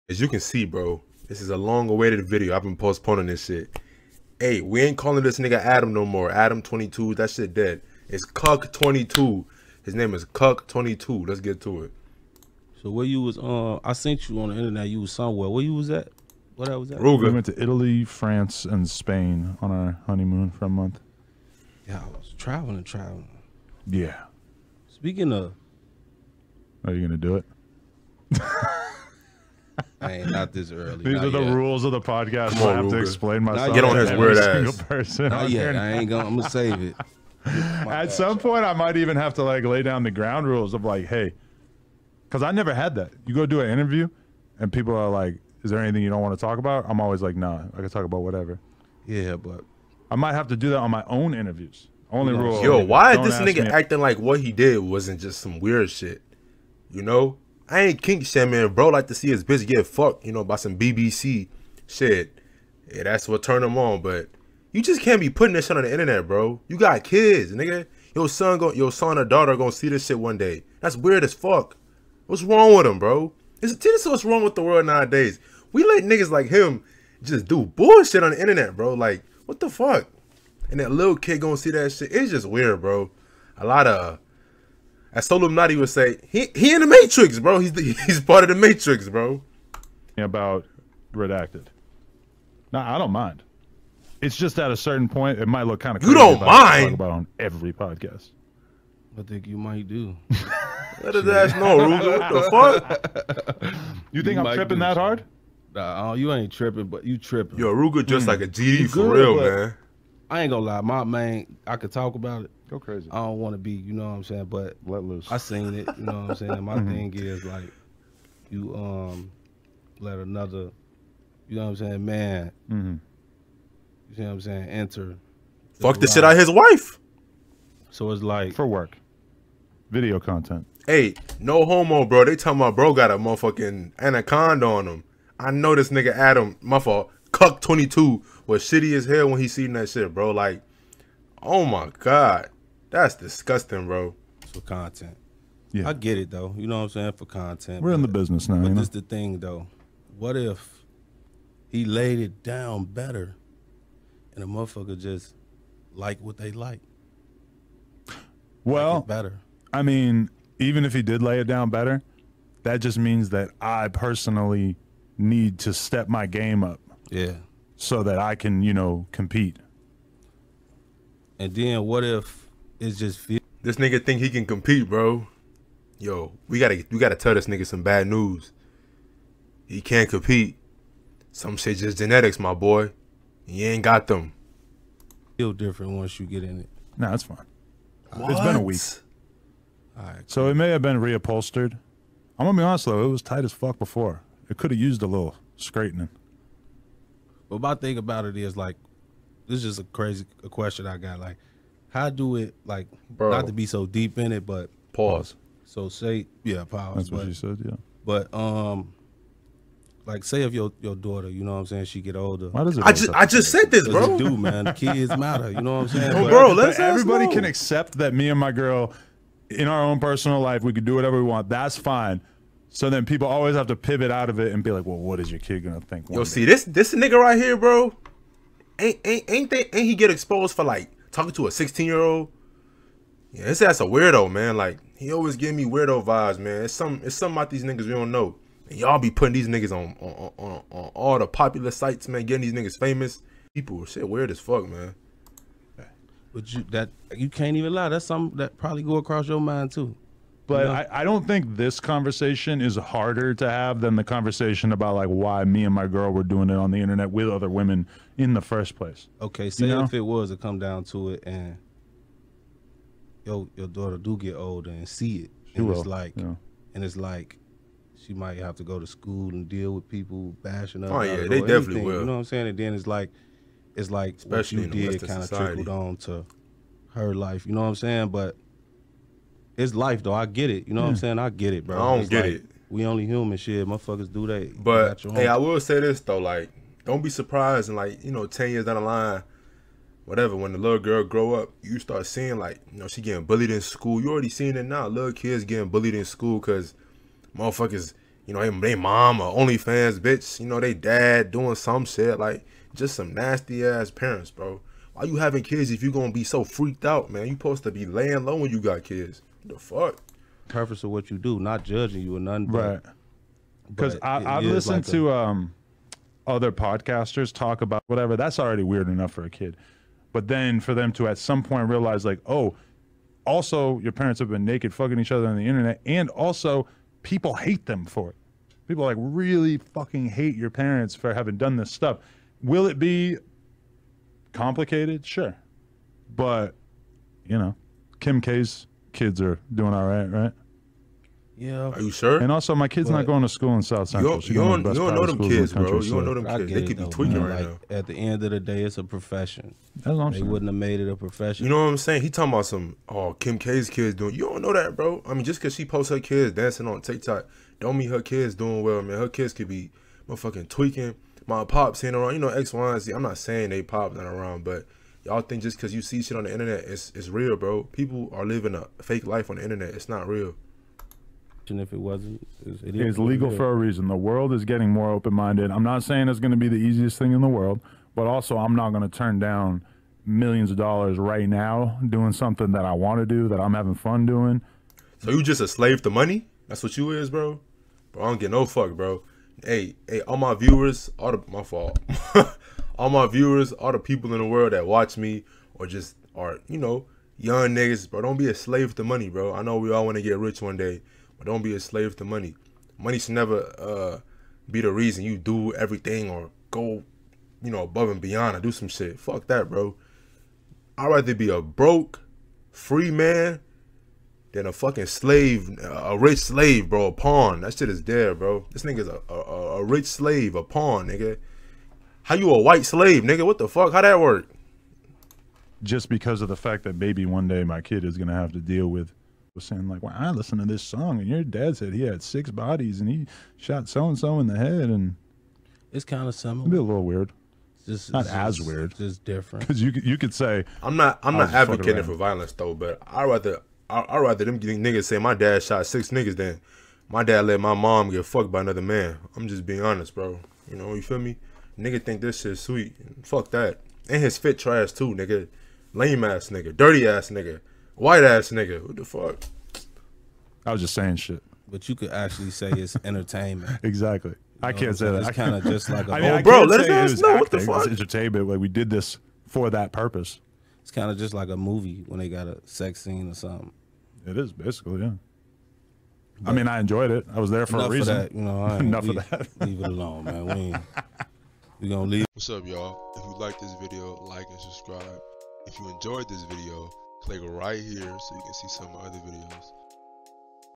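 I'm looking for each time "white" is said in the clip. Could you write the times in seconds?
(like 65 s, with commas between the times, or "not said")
422 s, 457 s.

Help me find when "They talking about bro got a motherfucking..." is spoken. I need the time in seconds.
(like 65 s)
132 s.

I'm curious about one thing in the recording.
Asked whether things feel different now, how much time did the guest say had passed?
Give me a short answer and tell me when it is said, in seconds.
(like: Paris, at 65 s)
A week, at 188 s.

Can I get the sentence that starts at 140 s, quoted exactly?
Like, oh my god, that's disgusting, bro.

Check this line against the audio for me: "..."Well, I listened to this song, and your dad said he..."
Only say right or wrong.
right.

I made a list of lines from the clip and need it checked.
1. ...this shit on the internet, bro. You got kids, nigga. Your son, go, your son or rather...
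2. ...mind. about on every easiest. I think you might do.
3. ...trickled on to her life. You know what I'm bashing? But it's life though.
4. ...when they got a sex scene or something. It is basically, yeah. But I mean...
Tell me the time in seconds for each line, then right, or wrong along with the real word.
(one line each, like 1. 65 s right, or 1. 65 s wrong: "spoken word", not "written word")
1. 65 s wrong: "daughter", not "rather"
2. 96 s wrong: "podcast", not "easiest"
3. 275 s wrong: "saying", not "bashing"
4. 471 s right.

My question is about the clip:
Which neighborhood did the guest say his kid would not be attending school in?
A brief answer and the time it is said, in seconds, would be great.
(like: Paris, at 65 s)
South Central, at 343 s.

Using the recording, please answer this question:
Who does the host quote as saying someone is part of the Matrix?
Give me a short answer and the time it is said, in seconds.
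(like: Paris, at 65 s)
Solomnati, at 85 s.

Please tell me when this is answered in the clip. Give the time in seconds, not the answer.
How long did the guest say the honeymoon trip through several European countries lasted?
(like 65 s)
20 s.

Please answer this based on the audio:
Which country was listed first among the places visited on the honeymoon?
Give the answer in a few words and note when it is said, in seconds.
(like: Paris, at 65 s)
Italy, at 17 s.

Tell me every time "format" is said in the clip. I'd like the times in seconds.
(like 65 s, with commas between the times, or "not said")
not said.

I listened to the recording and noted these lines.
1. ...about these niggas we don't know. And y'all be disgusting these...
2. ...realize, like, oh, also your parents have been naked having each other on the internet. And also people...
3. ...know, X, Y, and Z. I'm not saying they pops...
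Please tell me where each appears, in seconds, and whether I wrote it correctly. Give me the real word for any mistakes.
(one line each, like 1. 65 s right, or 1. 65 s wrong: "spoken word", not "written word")
1. 237 s wrong: "putting", not "disgusting"
2. 321 s wrong: "fucking", not "having"
3. 362 s right.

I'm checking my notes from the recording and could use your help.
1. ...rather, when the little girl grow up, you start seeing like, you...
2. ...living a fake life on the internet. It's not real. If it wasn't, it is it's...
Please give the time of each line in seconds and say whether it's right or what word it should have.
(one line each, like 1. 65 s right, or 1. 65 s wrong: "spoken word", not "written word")
1. 290 s wrong: "whatever", not "rather"
2. 368 s right.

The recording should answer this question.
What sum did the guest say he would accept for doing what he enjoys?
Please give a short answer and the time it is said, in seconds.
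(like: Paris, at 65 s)
Millions of dollars, at 380 s.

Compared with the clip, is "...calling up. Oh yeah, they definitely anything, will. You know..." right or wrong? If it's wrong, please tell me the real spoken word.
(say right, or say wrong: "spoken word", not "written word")
wrong: "bashing", not "calling".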